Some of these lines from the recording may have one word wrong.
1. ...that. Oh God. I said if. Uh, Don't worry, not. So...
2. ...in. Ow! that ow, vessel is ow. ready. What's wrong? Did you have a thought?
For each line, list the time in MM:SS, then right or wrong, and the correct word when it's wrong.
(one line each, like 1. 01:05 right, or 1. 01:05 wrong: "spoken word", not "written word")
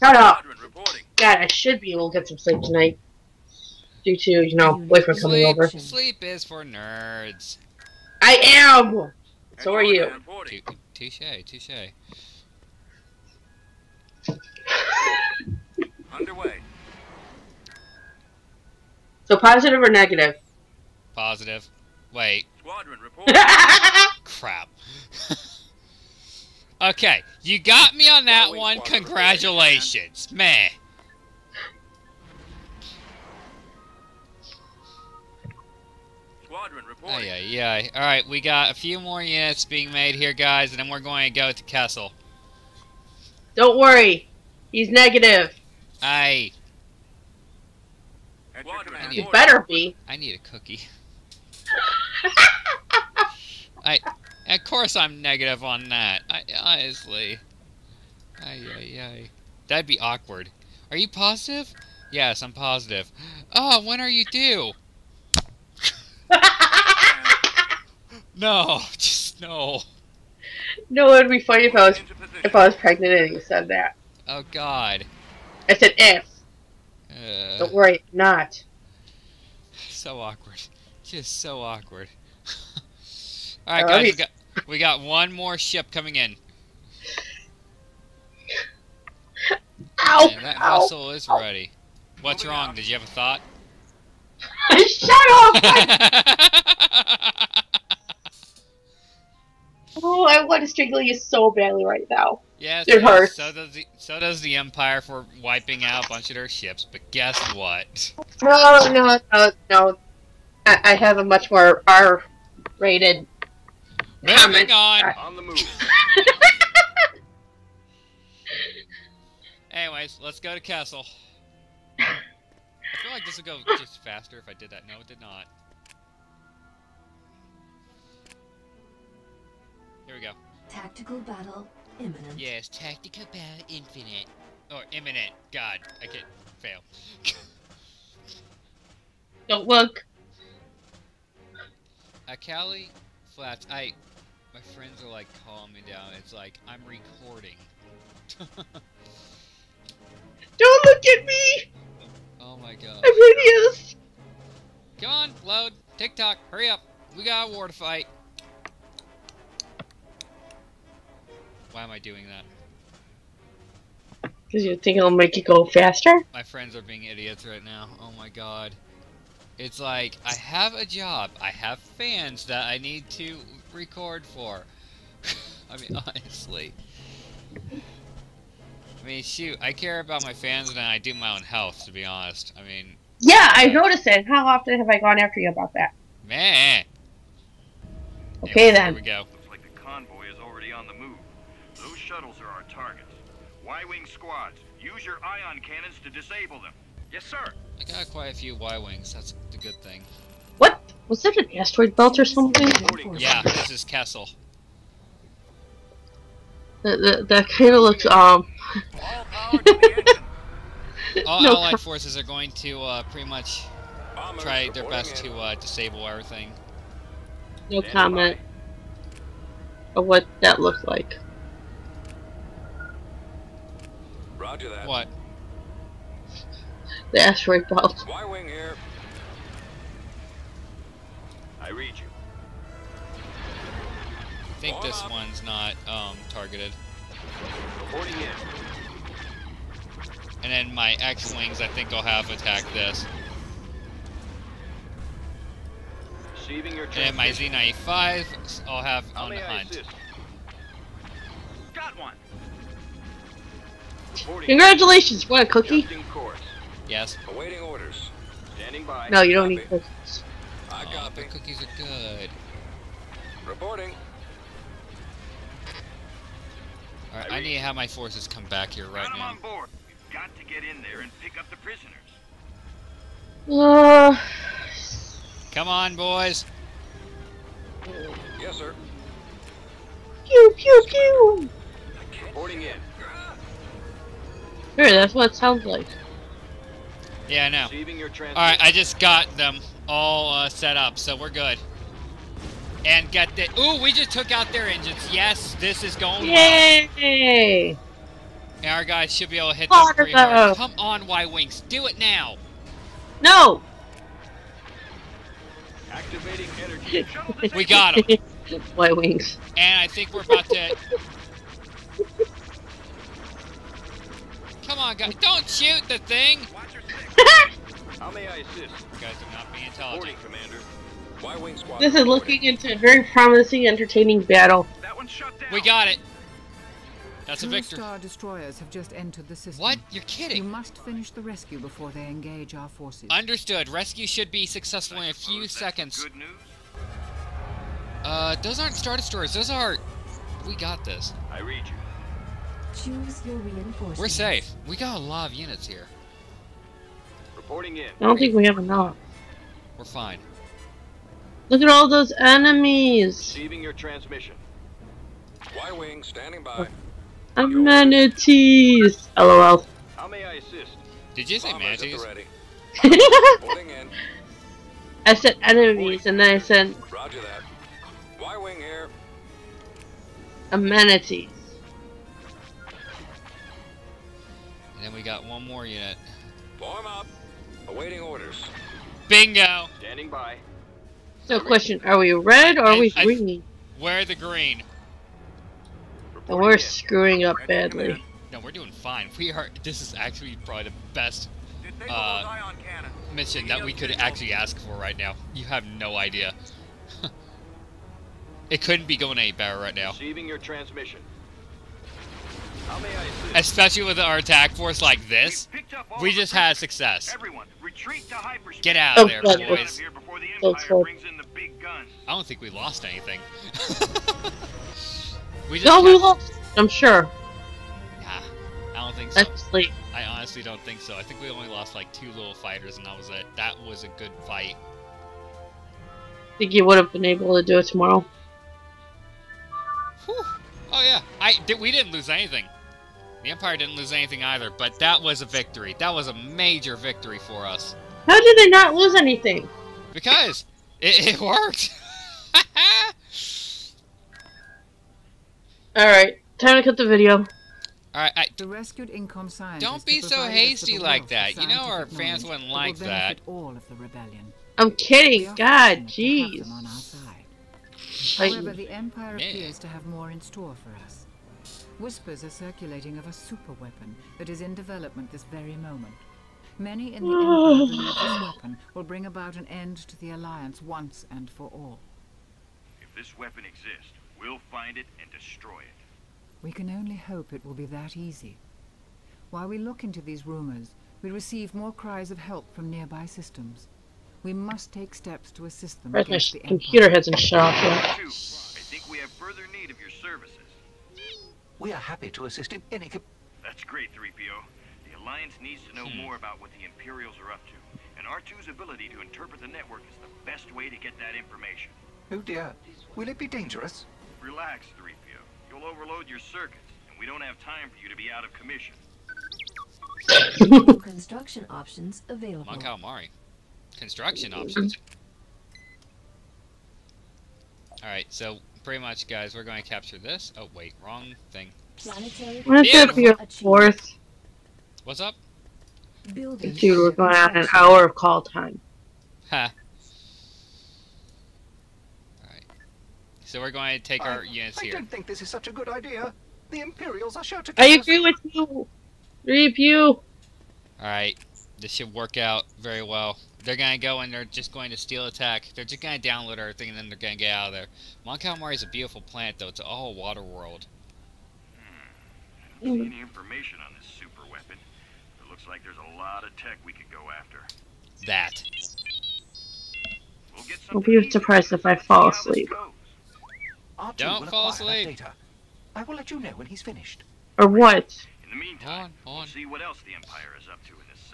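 1. 01:13 right
2. 01:26 right.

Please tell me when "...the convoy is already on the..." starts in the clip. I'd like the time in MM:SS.
03:09.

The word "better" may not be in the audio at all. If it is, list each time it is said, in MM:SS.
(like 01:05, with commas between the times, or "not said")
00:49, 06:39.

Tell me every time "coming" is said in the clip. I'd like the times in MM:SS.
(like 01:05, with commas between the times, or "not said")
00:05, 01:25, 01:54.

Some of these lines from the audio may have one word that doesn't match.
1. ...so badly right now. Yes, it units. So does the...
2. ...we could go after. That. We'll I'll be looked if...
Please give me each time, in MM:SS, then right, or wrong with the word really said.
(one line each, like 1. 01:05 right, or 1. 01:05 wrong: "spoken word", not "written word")
1. 01:41 wrong: "hurts", not "units"
2. 09:16 wrong: "surprised", not "looked".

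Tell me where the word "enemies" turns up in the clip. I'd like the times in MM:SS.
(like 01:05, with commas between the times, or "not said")
05:52, 06:05.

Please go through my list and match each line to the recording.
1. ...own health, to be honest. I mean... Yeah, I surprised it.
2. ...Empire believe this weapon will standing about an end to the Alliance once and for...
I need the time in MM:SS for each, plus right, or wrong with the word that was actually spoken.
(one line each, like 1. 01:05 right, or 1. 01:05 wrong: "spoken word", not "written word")
1. 03:01 wrong: "noticed", not "surprised"
2. 07:47 wrong: "bring", not "standing".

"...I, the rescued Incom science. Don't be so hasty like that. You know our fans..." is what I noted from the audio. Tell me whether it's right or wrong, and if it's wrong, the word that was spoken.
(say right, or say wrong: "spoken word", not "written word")
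right.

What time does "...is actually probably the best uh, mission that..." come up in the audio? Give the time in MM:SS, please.
06:29.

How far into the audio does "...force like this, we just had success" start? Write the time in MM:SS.
06:44.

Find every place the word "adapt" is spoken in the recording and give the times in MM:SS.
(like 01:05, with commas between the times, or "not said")
not said.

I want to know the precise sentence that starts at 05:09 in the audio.
And I think we're about to.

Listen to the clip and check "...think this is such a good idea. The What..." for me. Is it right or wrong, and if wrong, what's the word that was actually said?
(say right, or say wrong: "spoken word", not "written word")
wrong: "Imperials", not "What".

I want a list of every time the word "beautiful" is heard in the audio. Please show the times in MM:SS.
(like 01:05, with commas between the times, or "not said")
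09:08.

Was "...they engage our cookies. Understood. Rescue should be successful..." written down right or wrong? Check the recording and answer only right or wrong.
wrong.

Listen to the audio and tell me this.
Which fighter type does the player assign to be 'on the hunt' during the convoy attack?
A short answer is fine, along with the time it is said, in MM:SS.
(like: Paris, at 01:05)
Z95, at 04:07.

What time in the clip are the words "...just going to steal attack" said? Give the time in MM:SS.
09:04.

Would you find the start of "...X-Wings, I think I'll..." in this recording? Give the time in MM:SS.
04:01.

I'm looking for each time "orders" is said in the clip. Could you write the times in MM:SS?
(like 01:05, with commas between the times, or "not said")
04:17, 06:18.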